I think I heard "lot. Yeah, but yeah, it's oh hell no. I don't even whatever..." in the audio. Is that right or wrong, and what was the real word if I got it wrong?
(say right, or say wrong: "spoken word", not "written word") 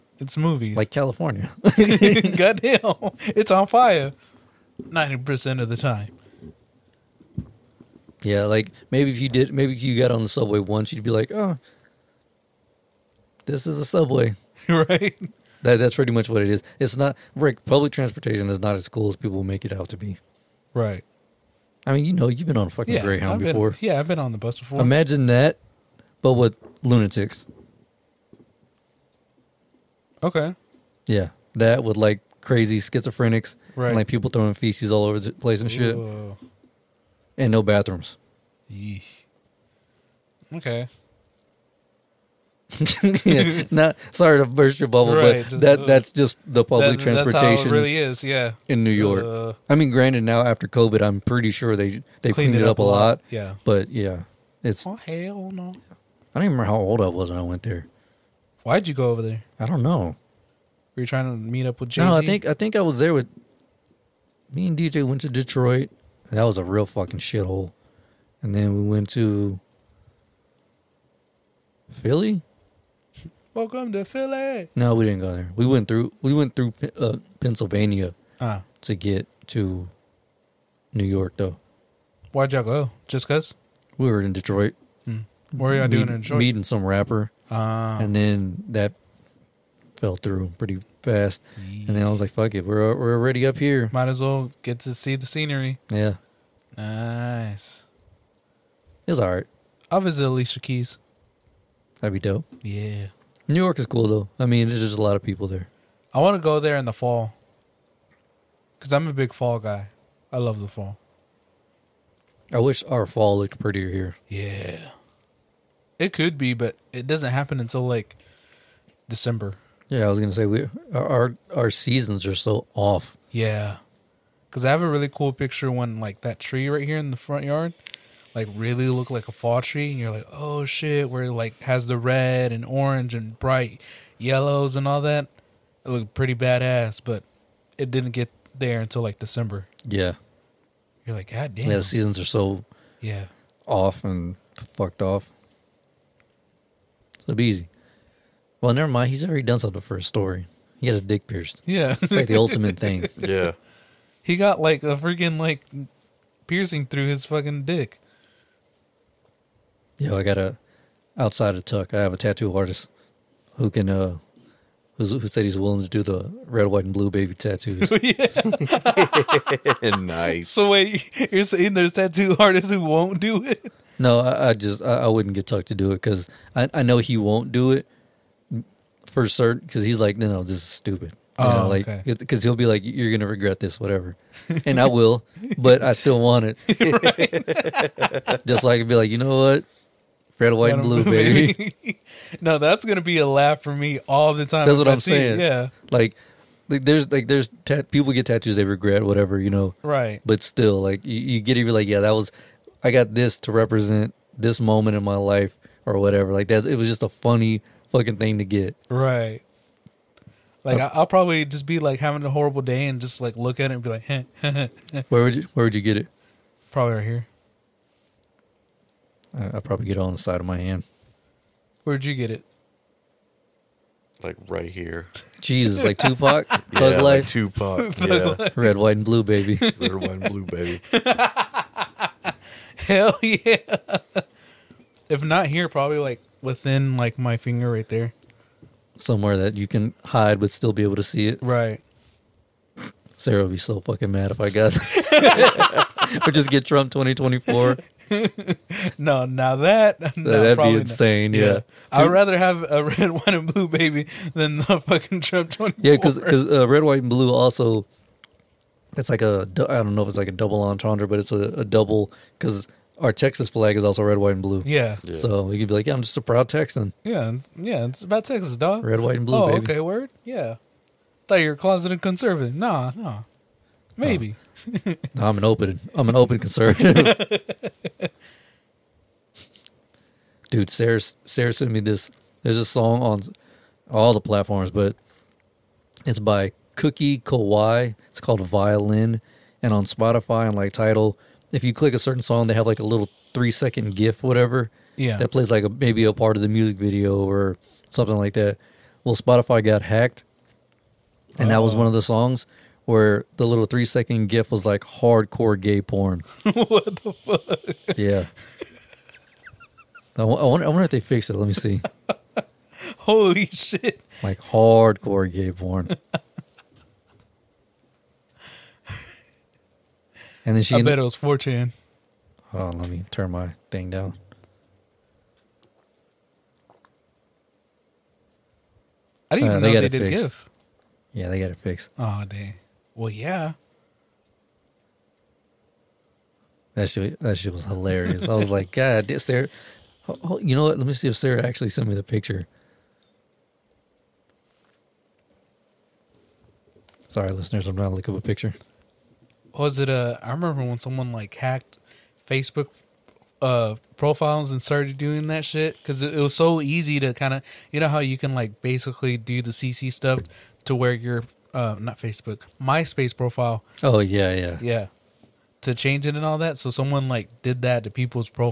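wrong: "remember", not "whatever".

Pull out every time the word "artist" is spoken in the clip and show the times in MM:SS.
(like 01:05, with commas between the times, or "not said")
02:42, 02:52.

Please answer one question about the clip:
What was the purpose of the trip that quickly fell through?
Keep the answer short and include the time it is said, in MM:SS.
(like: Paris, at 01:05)
Meeting some rapper, at 01:26.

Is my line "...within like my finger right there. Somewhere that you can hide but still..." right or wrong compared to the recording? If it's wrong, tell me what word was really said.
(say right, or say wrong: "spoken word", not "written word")
right.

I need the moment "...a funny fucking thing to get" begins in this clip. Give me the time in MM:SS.
03:27.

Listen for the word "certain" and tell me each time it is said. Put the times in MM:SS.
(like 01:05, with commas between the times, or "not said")
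02:59, 04:51.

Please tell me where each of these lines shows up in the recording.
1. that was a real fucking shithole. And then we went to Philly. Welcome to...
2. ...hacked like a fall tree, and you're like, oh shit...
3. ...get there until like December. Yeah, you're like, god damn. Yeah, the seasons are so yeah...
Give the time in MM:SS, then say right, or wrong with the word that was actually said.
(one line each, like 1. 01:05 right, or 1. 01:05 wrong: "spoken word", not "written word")
1. 01:06 right
2. 02:08 wrong: "looked", not "hacked"
3. 02:18 right.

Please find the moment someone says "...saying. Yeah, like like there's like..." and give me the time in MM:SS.
03:15.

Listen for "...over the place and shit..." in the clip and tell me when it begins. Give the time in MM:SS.
00:35.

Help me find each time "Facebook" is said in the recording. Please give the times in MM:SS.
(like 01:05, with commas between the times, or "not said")
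05:52, 06:01.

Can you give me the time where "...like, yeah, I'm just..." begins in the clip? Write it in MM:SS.
04:25.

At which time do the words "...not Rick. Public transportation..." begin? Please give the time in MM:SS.
00:16.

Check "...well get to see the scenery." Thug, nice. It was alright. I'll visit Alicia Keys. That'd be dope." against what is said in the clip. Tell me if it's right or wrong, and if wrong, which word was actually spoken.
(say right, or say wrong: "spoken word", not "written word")
wrong: "Yeah", not "Thug".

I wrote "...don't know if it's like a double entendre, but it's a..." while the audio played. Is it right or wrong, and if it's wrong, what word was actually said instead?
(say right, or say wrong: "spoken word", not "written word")
right.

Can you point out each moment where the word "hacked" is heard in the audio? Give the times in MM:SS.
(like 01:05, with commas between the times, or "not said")
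04:59, 05:51.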